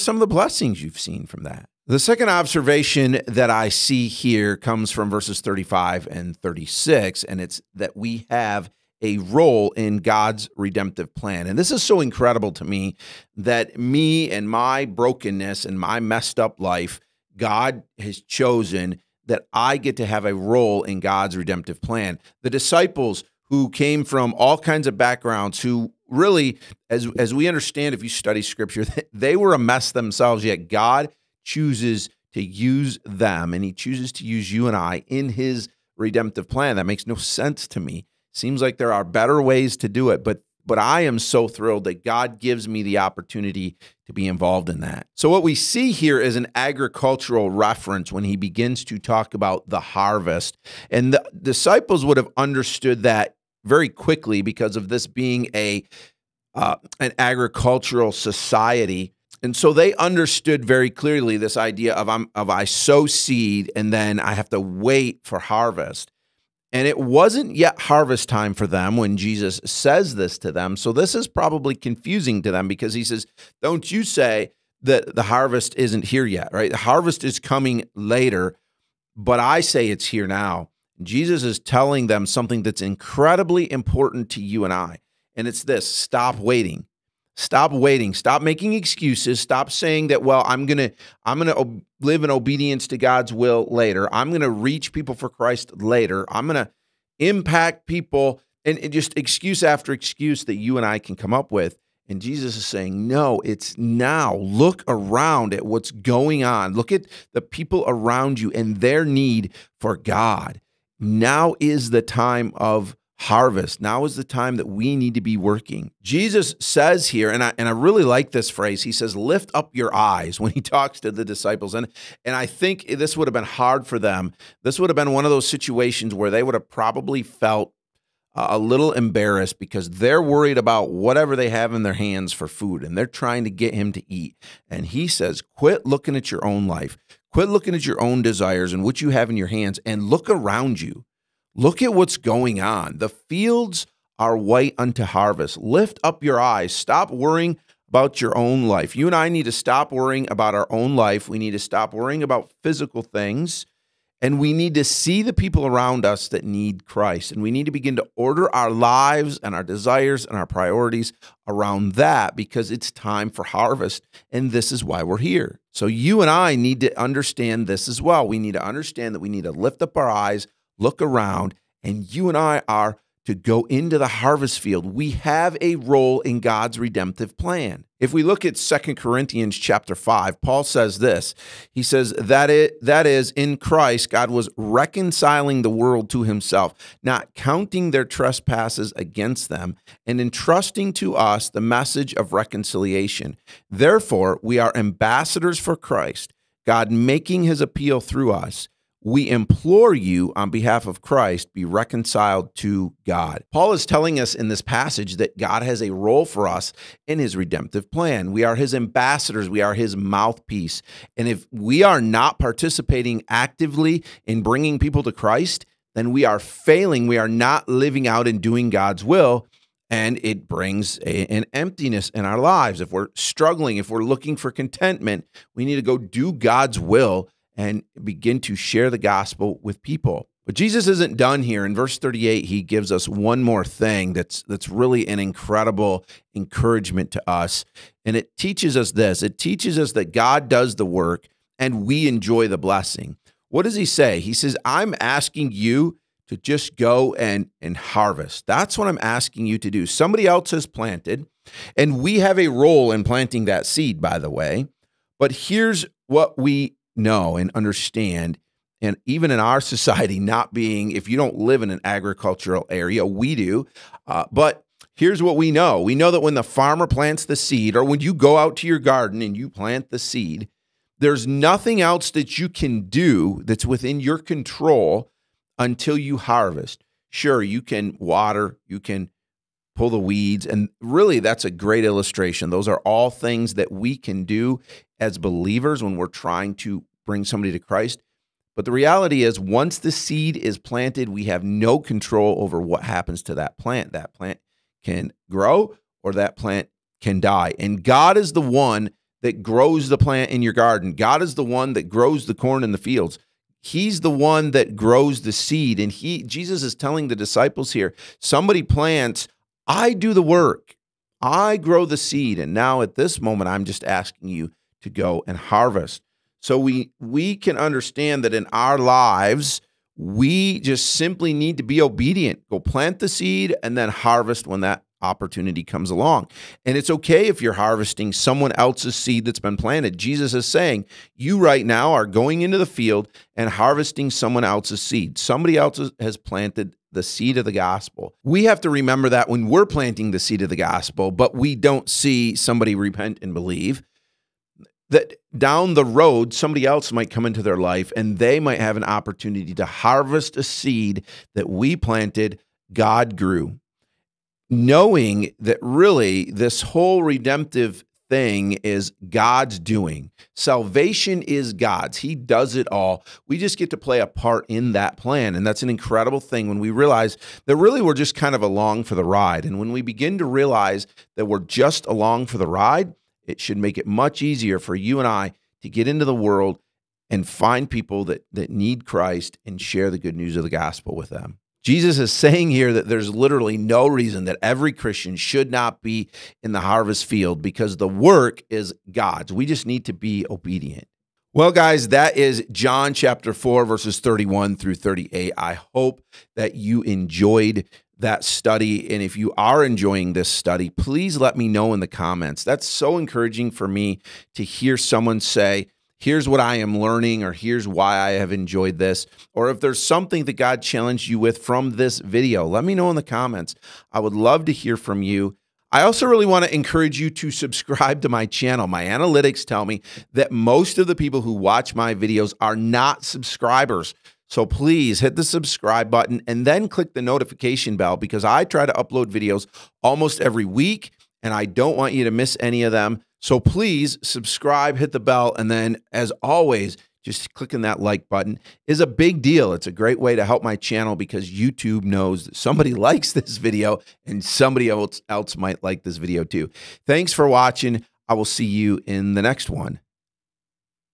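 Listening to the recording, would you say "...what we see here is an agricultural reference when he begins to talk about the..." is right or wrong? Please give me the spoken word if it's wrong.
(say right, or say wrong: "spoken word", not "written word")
right.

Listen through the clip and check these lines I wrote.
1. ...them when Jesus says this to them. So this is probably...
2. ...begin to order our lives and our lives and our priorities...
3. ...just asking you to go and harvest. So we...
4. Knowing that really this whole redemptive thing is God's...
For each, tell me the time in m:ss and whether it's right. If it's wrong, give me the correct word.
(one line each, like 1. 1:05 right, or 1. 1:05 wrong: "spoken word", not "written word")
1. 1:08 right
2. 2:37 wrong: "desires", not "lives"
3. 5:13 right
4. 5:54 right.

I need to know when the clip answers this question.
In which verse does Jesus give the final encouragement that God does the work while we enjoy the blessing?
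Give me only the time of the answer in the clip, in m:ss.
3:51.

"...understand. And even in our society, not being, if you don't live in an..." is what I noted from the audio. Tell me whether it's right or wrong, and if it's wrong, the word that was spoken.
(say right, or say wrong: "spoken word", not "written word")
right.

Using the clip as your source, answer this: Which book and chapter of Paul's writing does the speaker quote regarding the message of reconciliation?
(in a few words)
Second Corinthians 5.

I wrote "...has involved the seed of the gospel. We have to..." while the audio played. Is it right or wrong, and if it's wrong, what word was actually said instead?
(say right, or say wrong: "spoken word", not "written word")
wrong: "planted", not "involved".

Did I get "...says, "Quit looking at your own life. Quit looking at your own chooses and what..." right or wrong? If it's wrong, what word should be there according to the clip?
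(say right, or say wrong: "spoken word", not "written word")
wrong: "desires", not "chooses".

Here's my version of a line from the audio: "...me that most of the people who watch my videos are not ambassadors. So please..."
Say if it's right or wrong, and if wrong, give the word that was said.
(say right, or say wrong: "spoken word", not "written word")
wrong: "subscribers", not "ambassadors".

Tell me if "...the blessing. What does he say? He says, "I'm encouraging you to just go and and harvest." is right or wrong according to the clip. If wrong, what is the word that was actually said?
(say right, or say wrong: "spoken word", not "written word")
wrong: "asking", not "encouraging".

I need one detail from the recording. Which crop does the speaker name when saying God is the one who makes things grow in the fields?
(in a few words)
corn.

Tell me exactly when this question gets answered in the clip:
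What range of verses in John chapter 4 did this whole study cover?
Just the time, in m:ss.
6:33.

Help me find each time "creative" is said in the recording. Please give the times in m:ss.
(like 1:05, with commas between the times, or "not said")
not said.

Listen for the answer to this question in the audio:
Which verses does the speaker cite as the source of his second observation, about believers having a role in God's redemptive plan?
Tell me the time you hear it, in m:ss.
0:05.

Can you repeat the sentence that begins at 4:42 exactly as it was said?
Those are all things that we can do as believers when we're trying to bring somebody to Christ.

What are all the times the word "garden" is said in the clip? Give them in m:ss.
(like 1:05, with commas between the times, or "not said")
4:28, 5:00.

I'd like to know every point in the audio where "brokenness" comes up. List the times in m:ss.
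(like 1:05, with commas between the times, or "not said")
0:14.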